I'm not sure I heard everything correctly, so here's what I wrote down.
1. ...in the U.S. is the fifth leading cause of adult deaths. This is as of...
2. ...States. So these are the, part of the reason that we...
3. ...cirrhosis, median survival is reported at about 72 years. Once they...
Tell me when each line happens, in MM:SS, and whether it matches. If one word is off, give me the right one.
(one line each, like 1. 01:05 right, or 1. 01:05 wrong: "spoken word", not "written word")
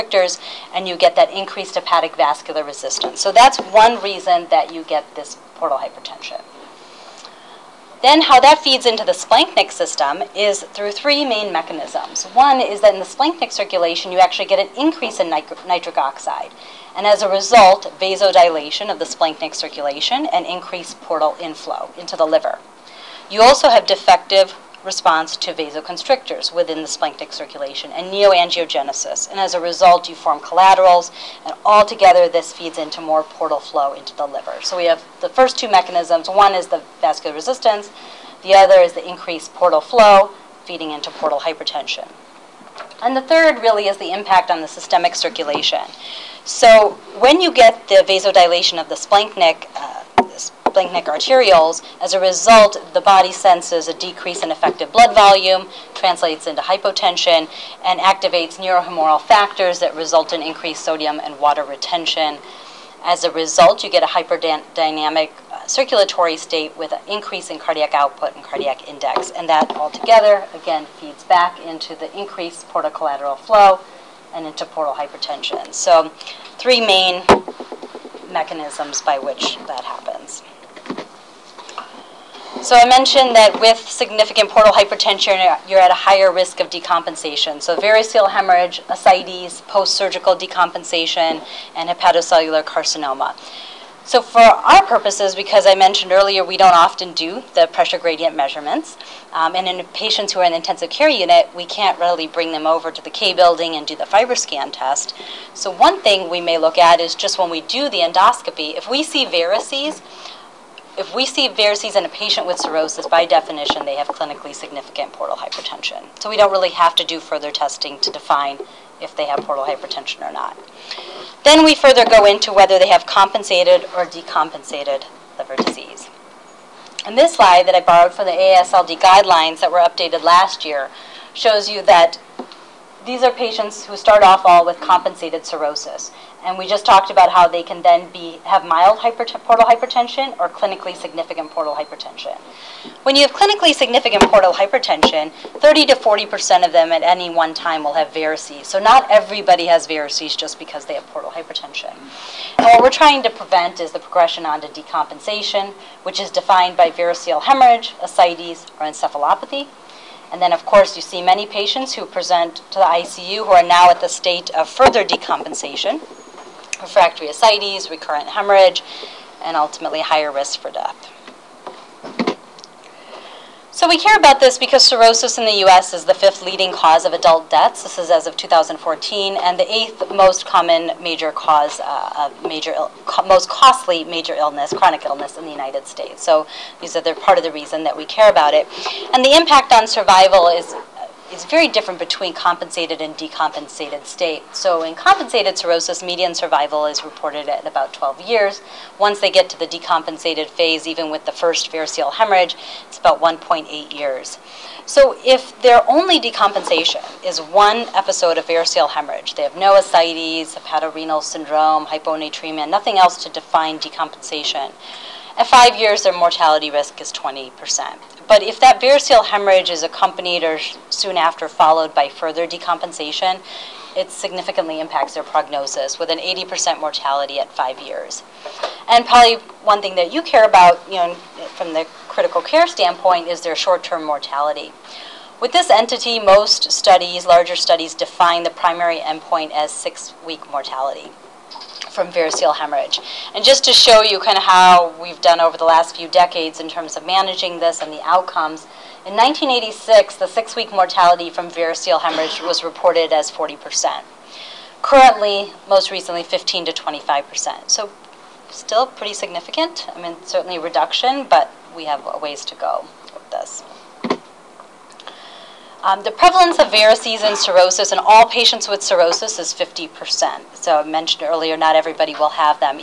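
1. 02:55 right
2. 03:05 right
3. 03:15 wrong: "12", not "72".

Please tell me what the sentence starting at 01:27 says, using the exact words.
So variceal hemorrhage, ascites, post-surgical decompensation, and hepatocellular carcinoma.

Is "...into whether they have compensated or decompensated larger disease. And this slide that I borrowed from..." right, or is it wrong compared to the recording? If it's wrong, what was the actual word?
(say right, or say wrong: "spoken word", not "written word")
wrong: "liver", not "larger".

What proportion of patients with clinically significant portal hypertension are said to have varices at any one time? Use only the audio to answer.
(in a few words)
30 to 40%.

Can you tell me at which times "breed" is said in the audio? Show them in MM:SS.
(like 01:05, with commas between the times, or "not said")
not said.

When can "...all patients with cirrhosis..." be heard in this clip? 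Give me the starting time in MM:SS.
04:27.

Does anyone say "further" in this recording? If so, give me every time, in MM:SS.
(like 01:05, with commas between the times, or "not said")
01:57, 02:01, 02:44, 03:42.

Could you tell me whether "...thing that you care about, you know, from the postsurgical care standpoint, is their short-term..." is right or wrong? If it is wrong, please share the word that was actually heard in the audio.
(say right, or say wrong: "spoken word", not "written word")
wrong: "critical", not "postsurgical".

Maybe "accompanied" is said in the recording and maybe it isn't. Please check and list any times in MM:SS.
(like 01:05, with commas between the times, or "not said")
03:39.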